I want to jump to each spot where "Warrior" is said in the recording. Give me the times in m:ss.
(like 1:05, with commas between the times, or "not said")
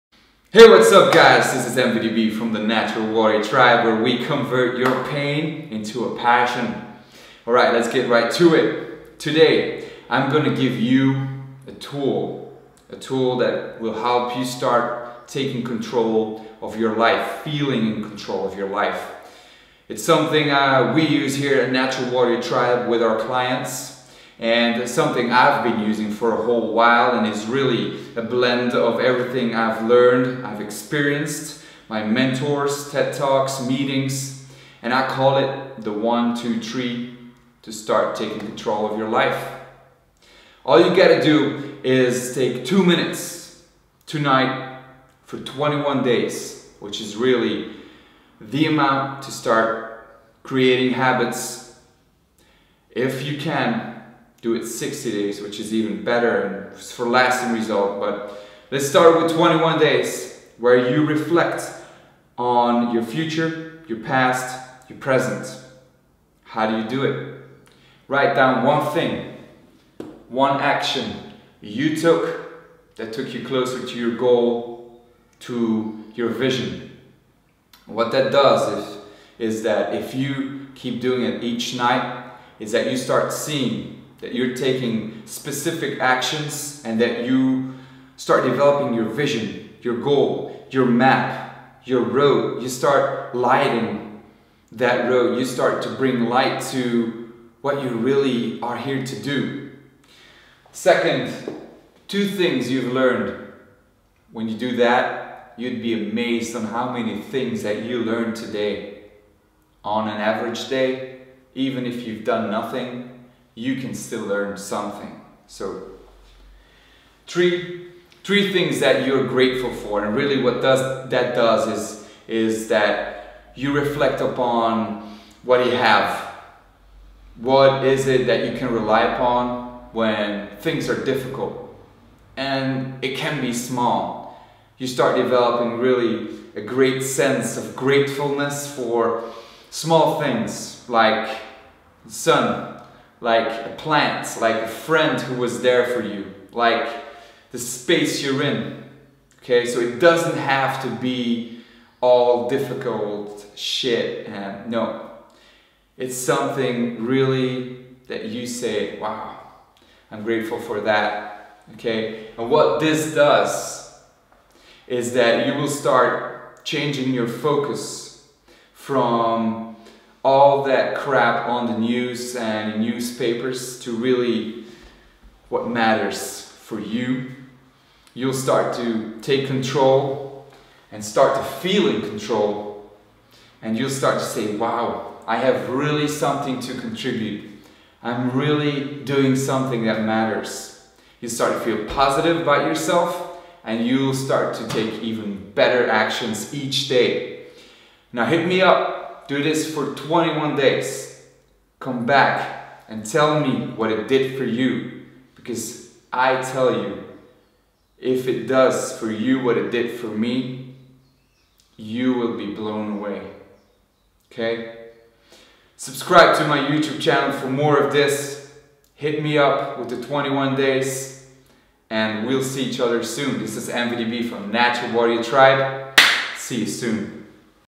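0:03, 0:22, 3:44.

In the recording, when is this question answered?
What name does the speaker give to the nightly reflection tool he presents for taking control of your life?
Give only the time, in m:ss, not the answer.
0:35.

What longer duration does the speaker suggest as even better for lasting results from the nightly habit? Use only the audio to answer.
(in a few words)
60 days.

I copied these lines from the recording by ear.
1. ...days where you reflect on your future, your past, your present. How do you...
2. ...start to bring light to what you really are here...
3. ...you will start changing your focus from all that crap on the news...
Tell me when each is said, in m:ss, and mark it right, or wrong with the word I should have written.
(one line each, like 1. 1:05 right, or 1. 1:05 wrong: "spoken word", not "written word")
1. 0:59 right
2. 1:35 right
3. 2:45 right.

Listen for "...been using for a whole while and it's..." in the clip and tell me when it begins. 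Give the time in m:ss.
0:25.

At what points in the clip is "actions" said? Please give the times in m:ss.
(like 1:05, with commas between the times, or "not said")
1:10, 1:25, 3:15.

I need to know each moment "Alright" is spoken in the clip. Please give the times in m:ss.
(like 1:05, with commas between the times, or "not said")
0:07.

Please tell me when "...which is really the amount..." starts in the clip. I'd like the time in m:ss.
0:46.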